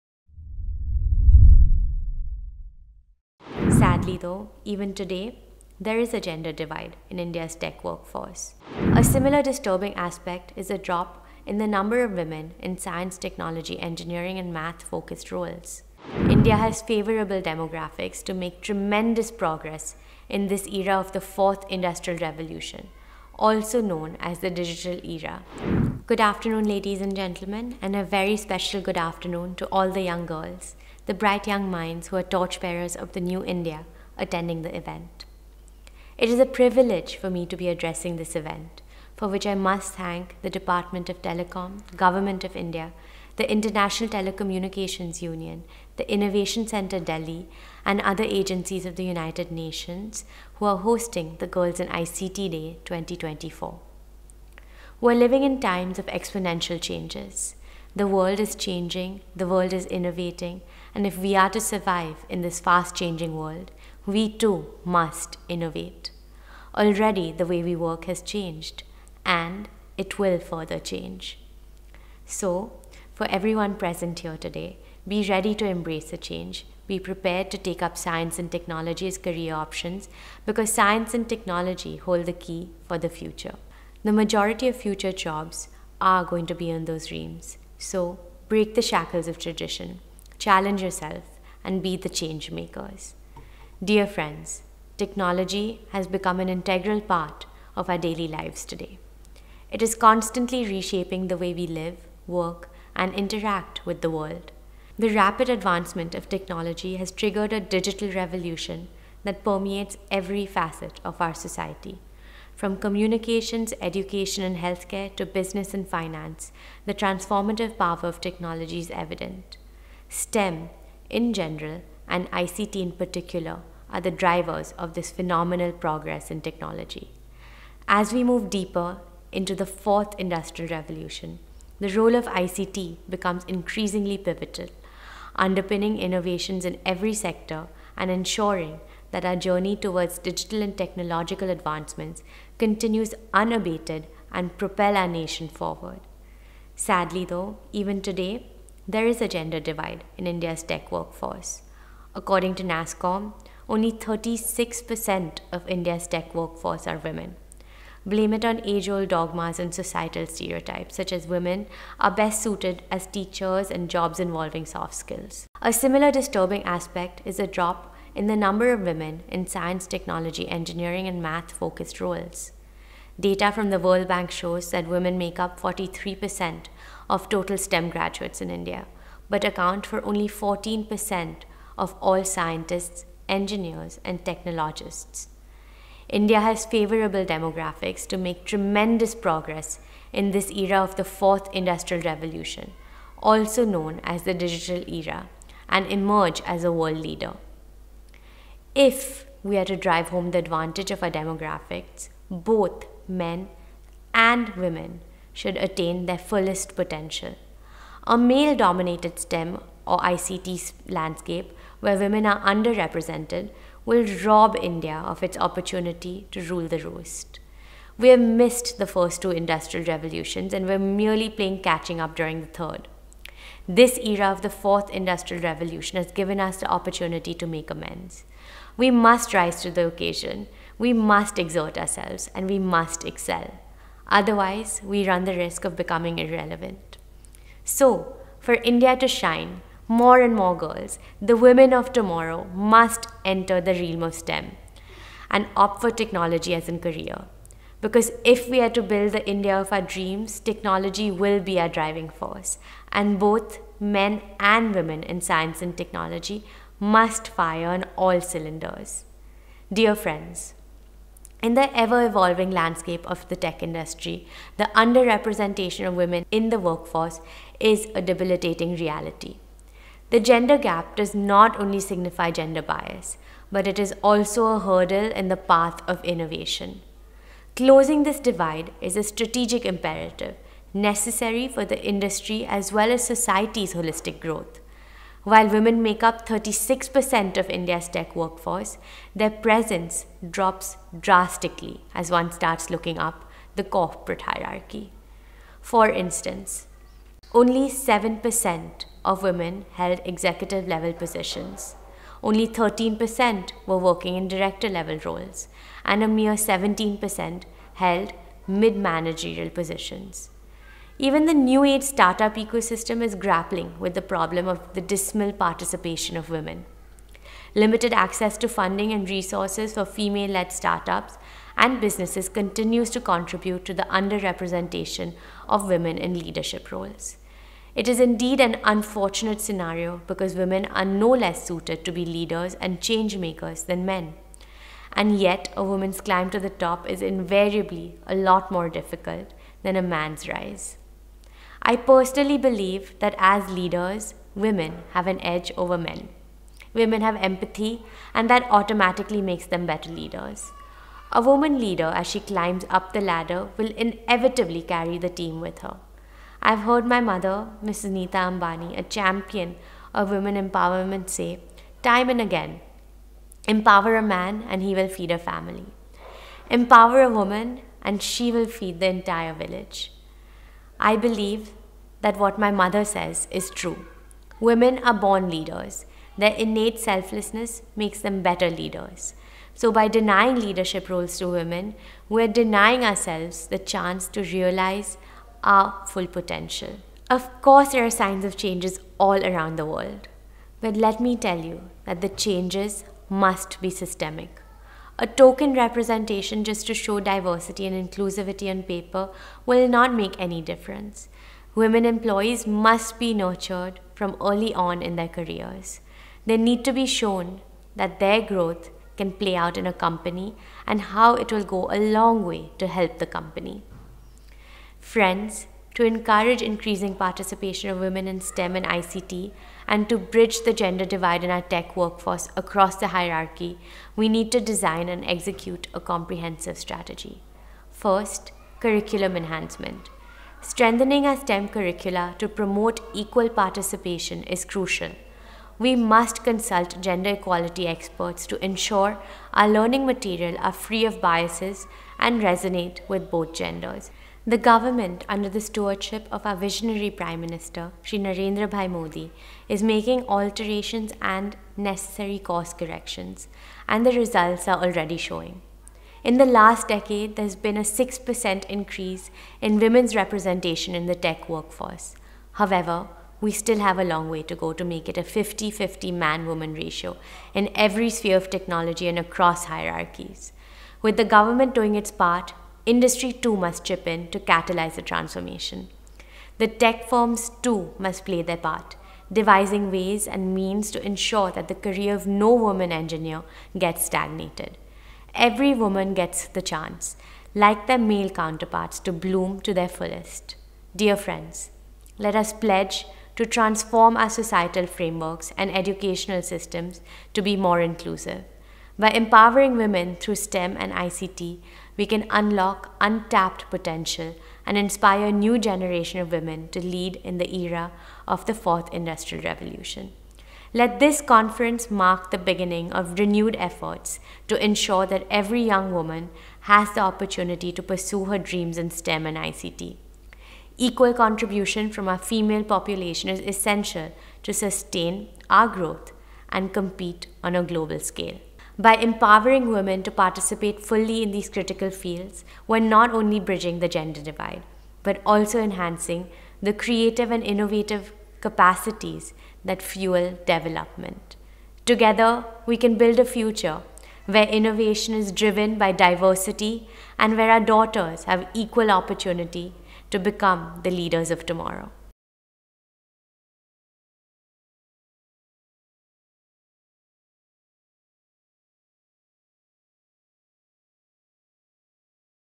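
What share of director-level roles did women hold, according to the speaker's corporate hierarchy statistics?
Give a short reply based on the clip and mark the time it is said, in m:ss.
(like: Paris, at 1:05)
13%, at 5:02.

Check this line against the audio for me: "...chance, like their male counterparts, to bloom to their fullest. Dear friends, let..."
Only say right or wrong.
right.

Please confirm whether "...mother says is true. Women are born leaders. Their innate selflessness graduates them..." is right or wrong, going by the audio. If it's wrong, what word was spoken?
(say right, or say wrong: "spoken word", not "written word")
wrong: "makes", not "graduates".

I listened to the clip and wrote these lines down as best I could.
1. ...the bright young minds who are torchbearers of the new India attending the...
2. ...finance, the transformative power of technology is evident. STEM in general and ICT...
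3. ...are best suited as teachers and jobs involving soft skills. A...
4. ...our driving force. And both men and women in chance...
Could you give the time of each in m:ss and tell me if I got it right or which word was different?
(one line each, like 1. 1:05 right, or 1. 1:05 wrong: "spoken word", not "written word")
1. 0:31 right
2. 1:55 right
3. 2:41 right
4. 4:11 wrong: "science", not "chance".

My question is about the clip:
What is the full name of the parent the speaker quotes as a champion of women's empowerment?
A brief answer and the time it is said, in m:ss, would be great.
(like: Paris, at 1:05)
Nita Ambani, at 5:57.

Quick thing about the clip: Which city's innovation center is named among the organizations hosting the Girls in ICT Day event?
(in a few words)
Delhi.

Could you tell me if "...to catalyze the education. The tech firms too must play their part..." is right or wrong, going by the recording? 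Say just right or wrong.
wrong.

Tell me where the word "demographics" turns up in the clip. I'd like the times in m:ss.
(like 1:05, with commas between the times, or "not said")
0:17, 3:07, 3:21.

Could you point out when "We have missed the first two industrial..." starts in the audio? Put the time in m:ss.
3:37.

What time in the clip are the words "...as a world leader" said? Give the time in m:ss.
3:16.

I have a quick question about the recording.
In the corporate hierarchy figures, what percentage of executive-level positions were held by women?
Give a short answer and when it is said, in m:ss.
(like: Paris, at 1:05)
7%, at 4:57.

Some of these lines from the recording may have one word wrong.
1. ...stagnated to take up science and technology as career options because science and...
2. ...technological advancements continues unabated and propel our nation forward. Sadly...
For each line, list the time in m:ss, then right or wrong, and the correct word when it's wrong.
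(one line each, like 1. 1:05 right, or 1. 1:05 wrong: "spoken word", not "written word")
1. 1:16 wrong: "prepared", not "stagnated"
2. 2:20 right.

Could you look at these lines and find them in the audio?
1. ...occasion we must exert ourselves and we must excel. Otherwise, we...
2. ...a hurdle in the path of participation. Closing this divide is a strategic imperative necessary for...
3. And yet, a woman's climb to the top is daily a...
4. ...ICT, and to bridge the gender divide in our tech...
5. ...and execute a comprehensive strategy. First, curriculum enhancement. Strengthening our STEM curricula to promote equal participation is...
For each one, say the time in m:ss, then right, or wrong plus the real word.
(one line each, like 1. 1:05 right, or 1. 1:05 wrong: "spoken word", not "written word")
1. 3:49 right
2. 4:34 wrong: "innovation", not "participation"
3. 5:34 wrong: "invariably", not "daily"
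4. 6:58 right
5. 7:04 right.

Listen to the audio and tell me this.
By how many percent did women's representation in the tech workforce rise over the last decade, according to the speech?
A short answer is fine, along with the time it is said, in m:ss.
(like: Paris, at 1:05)
6%, at 7:37.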